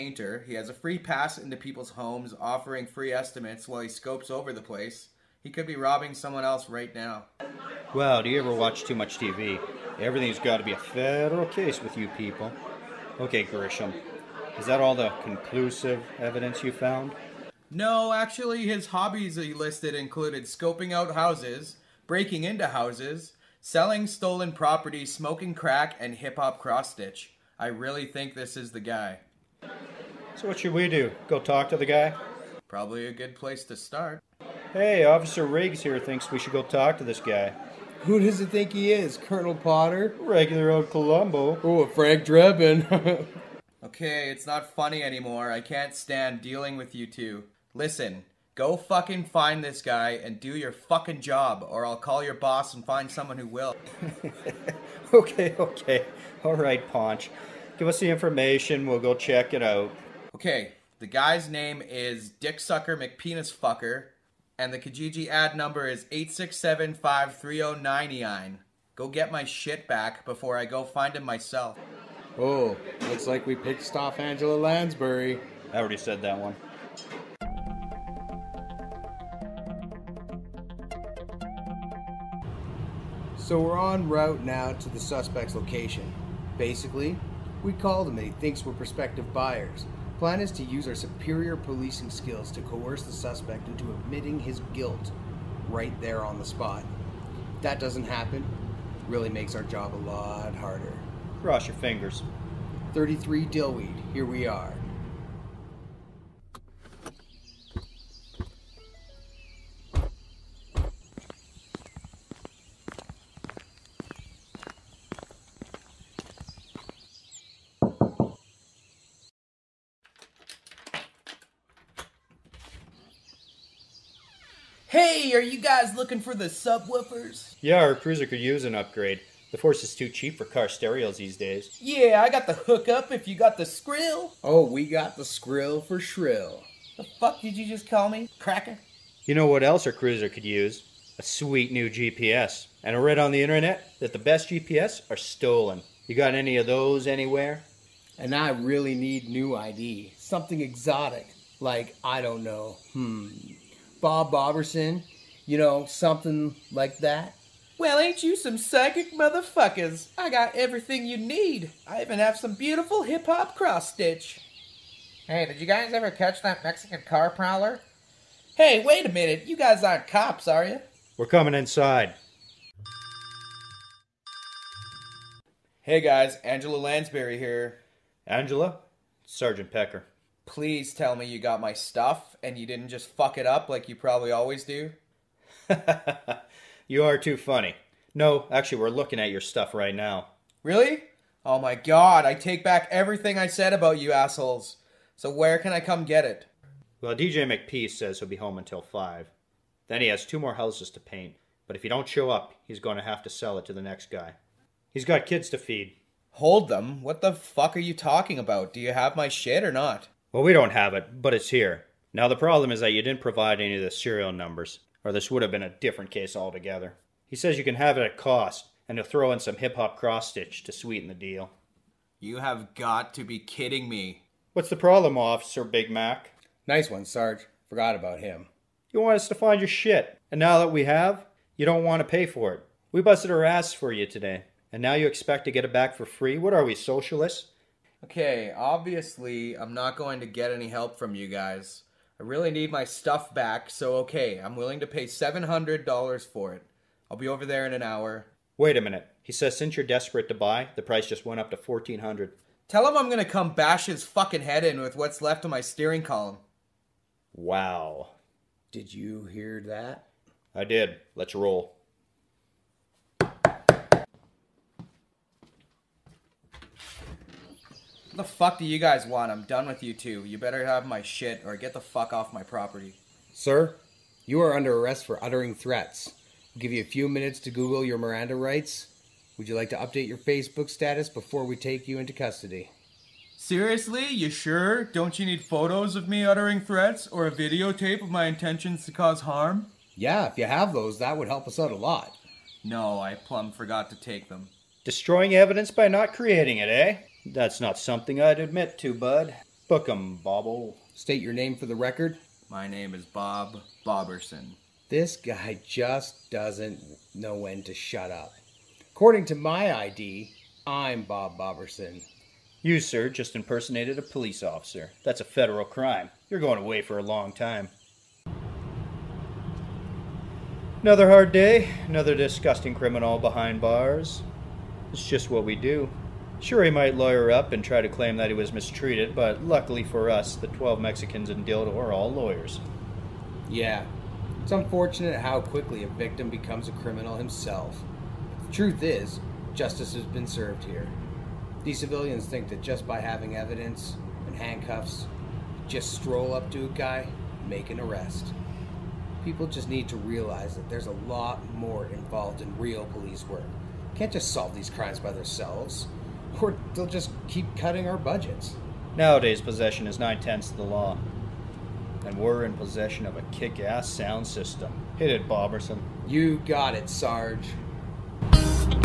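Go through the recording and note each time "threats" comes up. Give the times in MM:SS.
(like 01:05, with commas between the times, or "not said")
04:35, 04:46.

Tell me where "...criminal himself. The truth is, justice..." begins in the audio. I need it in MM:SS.
05:36.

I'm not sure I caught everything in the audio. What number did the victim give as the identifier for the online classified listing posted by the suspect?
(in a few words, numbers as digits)
8675309.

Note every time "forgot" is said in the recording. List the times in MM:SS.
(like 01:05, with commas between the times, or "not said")
03:47, 04:53.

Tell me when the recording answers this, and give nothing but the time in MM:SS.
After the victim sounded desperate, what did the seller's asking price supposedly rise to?
04:11.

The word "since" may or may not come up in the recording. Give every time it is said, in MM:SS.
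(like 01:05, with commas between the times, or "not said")
04:09.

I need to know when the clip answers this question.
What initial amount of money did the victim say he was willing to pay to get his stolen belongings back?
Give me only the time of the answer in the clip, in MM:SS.
04:05.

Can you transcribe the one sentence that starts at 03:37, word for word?
He says you can have it at cost, and he'll throw in some hip hop cross stitch to sweeten the deal.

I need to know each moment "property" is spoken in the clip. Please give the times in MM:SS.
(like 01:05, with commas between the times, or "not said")
00:24, 04:32.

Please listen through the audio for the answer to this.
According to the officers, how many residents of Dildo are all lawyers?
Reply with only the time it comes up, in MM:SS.
05:30.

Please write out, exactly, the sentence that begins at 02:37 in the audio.
Well, ain't you some psychic motherfuckers?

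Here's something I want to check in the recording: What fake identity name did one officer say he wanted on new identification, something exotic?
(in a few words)
Bob Boberson.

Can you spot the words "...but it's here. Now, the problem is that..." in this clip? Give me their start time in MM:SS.
03:31.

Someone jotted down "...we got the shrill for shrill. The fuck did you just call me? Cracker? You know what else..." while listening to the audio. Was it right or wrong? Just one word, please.
wrong.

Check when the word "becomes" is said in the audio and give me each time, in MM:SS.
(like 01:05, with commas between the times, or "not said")
05:36.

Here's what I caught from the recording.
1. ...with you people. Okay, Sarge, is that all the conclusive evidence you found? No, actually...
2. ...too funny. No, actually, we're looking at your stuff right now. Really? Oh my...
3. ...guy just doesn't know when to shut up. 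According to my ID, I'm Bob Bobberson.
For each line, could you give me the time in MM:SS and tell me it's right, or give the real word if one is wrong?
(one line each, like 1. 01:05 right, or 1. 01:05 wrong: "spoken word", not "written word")
1. 00:11 wrong: "Grissom", not "Sarge"
2. 03:07 right
3. 05:05 right.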